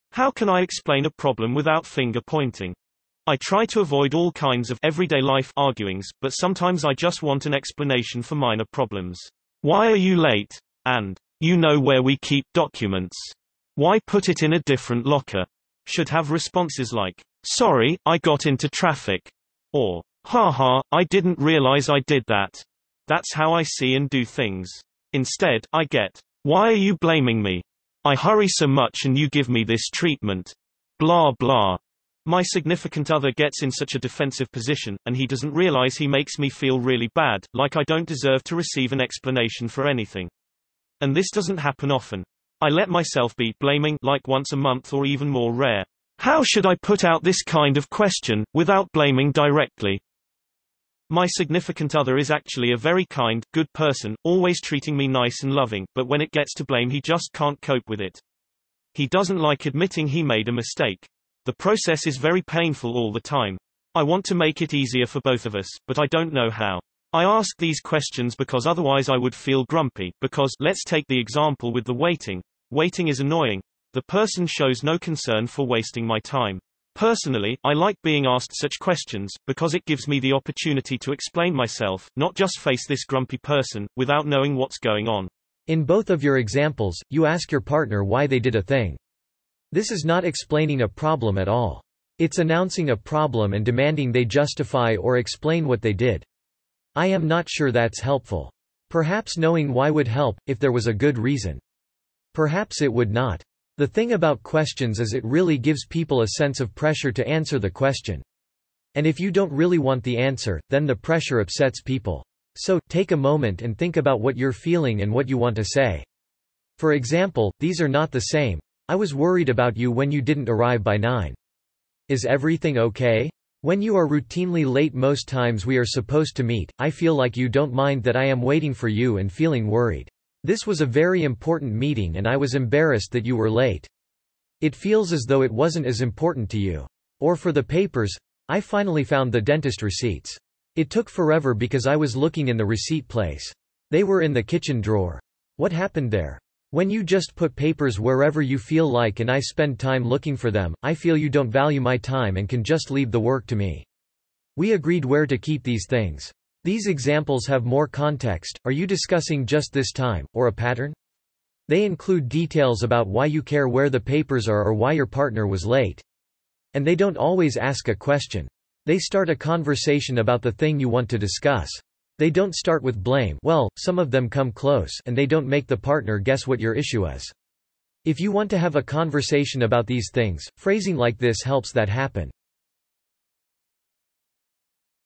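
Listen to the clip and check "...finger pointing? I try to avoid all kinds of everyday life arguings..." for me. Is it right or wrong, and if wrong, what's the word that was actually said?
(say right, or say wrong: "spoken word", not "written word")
right.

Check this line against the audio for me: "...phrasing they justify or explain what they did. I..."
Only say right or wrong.
wrong.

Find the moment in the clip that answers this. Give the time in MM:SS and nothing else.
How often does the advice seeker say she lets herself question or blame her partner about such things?
00:44.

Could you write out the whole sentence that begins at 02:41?
They include details about why you care where the papers are or why your partner was late.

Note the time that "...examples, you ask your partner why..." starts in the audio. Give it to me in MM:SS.
01:26.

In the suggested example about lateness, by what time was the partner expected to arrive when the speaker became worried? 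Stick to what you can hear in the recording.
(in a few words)
9.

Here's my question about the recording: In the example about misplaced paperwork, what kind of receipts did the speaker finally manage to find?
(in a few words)
dentist receipts.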